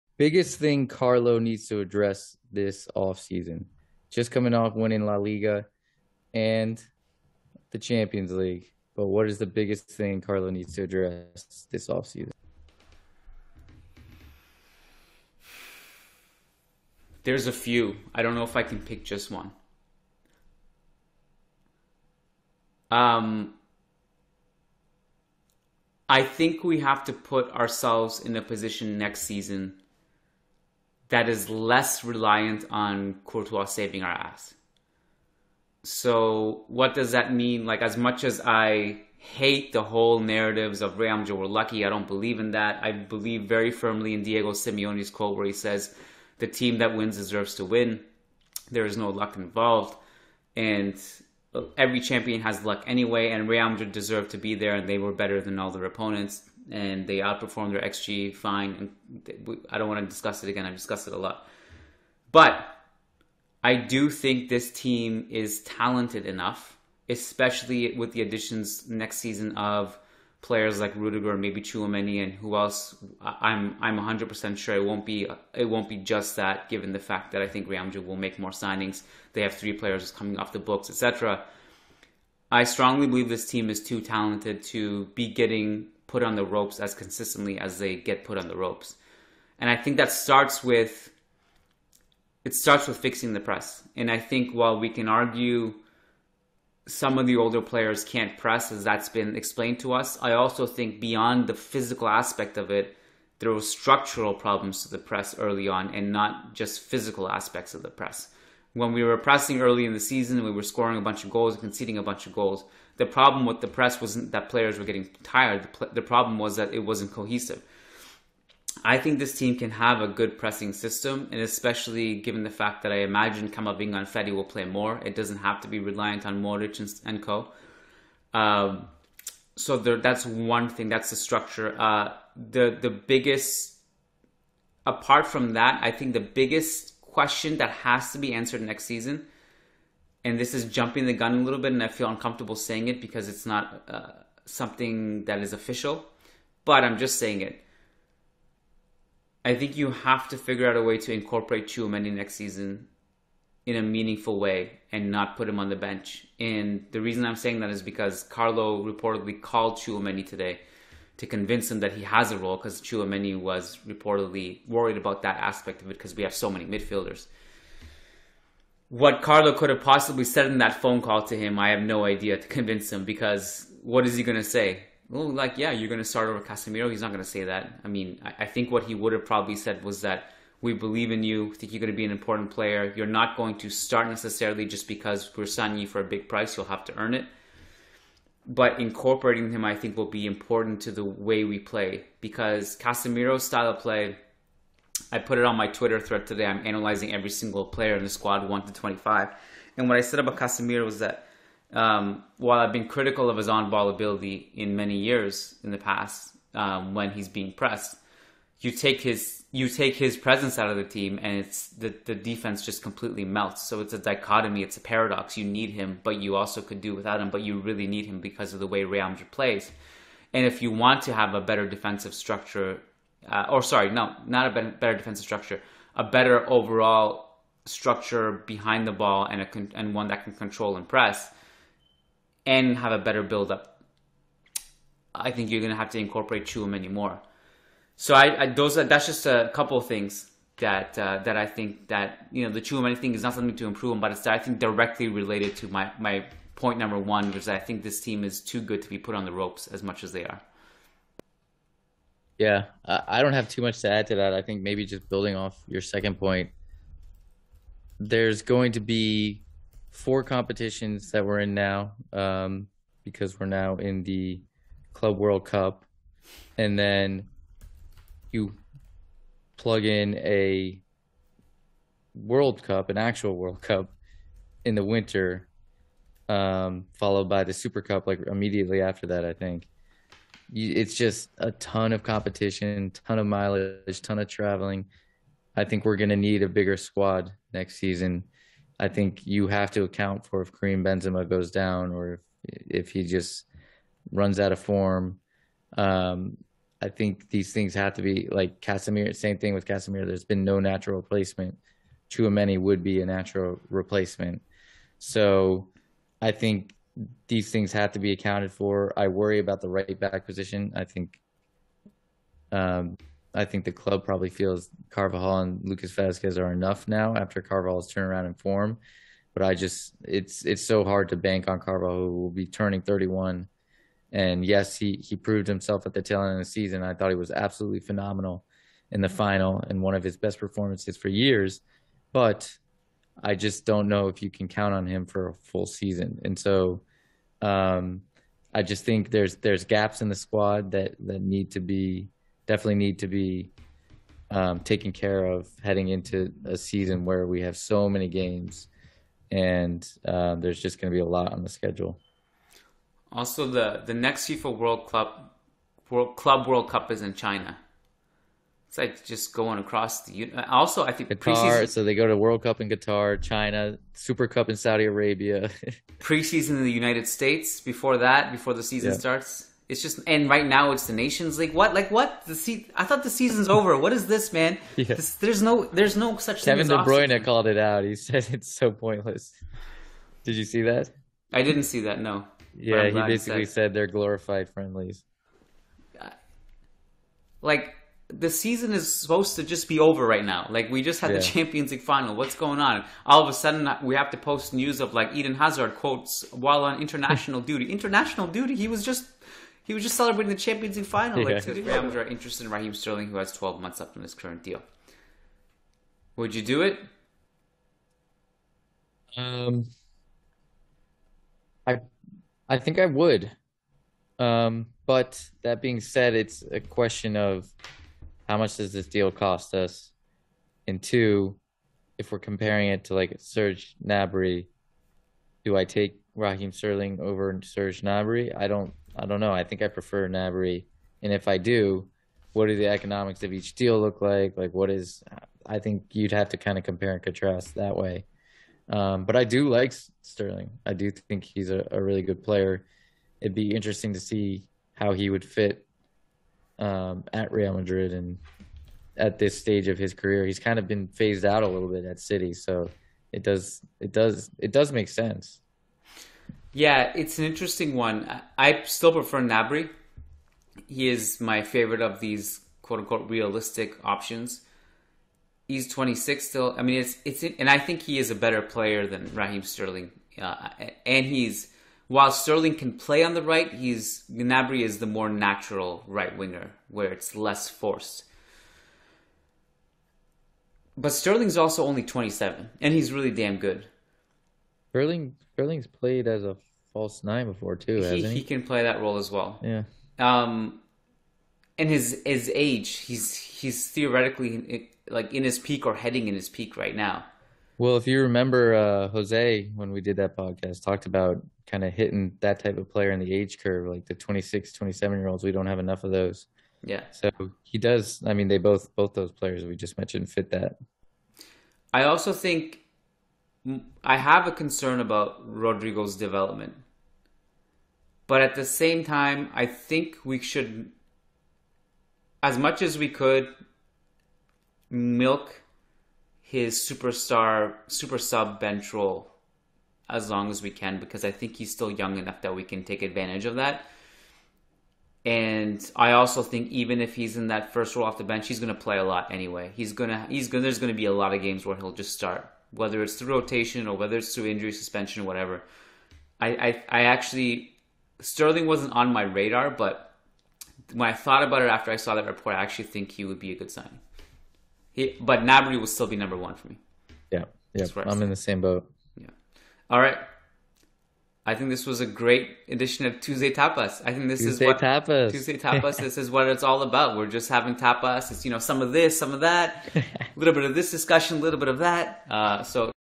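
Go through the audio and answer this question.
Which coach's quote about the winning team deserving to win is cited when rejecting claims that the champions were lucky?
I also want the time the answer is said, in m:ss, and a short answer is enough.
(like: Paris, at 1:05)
Diego Simeone, at 0:44.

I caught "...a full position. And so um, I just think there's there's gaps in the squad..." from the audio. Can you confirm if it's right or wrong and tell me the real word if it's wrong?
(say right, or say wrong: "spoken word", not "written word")
wrong: "season", not "position".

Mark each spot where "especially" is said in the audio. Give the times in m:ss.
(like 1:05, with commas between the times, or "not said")
1:07, 2:01.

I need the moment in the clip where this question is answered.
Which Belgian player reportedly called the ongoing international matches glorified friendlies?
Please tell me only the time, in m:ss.
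6:16.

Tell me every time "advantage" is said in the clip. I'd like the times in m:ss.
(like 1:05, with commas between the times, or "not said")
8:52.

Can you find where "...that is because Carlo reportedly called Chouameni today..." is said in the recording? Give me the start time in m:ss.
2:37.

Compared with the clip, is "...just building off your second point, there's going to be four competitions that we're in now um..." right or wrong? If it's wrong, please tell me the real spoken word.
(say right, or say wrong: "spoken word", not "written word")
right.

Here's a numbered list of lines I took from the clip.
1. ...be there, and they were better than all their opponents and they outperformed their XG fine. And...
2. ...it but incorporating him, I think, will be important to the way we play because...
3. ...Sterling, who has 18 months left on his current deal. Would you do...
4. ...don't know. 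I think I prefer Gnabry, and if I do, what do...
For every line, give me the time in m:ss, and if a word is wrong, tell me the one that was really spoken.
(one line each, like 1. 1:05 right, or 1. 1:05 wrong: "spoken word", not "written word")
1. 0:54 right
2. 3:07 right
3. 6:42 wrong: "12", not "18"
4. 7:09 right.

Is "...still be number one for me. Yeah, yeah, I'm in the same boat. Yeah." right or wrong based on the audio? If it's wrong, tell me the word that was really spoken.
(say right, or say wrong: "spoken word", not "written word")
right.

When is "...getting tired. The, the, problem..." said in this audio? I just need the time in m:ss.
1:54.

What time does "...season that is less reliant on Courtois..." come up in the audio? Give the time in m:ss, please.
0:29.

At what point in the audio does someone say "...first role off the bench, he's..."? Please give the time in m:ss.
8:57.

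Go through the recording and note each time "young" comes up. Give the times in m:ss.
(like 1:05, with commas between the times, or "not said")
8:51.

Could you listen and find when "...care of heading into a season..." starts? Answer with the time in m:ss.
5:44.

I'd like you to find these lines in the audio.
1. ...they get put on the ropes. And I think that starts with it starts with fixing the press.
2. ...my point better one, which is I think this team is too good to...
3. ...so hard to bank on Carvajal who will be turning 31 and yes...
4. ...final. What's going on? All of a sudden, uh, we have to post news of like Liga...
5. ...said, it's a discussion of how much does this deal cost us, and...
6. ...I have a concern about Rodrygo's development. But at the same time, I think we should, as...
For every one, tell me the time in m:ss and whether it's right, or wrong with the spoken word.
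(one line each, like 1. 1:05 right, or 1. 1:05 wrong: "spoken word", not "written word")
1. 1:27 right
2. 4:05 wrong: "number", not "better"
3. 5:20 right
4. 6:31 wrong: "Eden", not "Liga"
5. 6:55 wrong: "question", not "discussion"
6. 8:33 right.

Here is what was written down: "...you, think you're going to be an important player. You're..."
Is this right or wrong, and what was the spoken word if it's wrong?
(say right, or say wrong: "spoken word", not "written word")
right.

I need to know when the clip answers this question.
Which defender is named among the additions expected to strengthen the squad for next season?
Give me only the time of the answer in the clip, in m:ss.
1:10.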